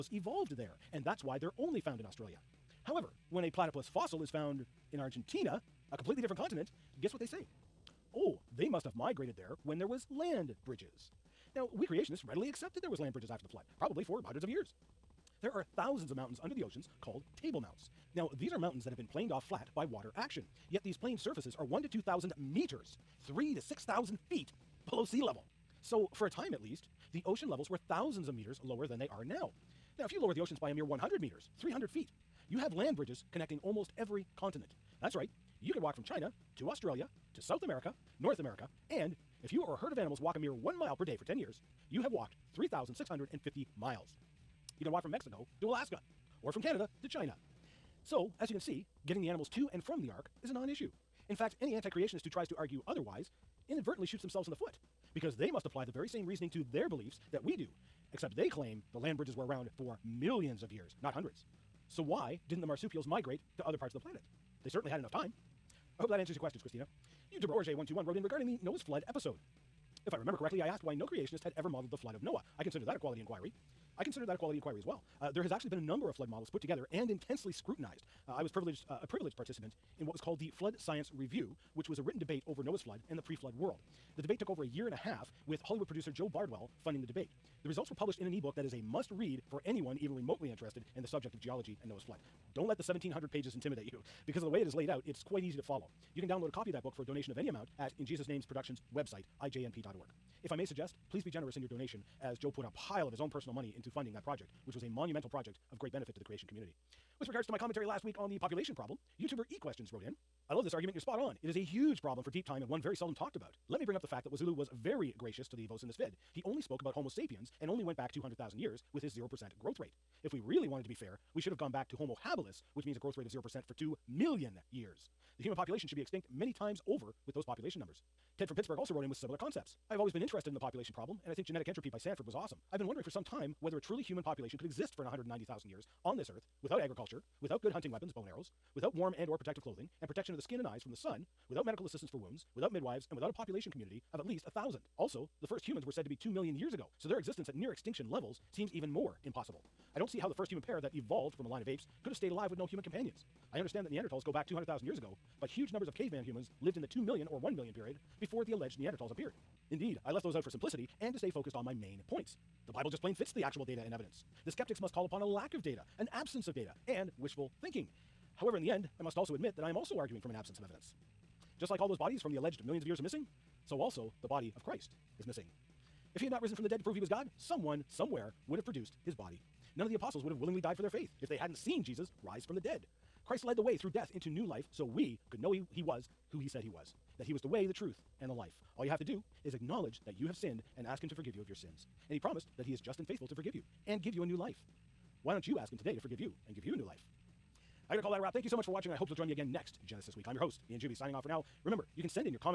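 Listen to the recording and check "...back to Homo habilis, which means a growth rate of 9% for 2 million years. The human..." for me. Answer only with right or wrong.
wrong.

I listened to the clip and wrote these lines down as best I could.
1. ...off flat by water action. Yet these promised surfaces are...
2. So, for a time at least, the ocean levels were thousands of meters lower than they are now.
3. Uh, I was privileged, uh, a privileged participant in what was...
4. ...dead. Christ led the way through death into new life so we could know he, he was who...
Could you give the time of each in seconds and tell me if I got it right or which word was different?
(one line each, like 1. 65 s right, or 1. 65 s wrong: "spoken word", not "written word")
1. 19 s wrong: "planed", not "promised"
2. 25 s right
3. 78 s right
4. 182 s right.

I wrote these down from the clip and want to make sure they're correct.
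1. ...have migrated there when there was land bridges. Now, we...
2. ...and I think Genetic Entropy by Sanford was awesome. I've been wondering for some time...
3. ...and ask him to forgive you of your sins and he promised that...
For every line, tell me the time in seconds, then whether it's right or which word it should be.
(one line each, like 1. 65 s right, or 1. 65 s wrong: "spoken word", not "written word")
1. 8 s right
2. 131 s right
3. 190 s right.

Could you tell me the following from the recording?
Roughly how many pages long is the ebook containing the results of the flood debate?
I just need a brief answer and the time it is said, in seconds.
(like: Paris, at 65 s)
1700, at 92 s.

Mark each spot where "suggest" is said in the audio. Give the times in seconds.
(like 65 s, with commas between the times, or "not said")
100 s.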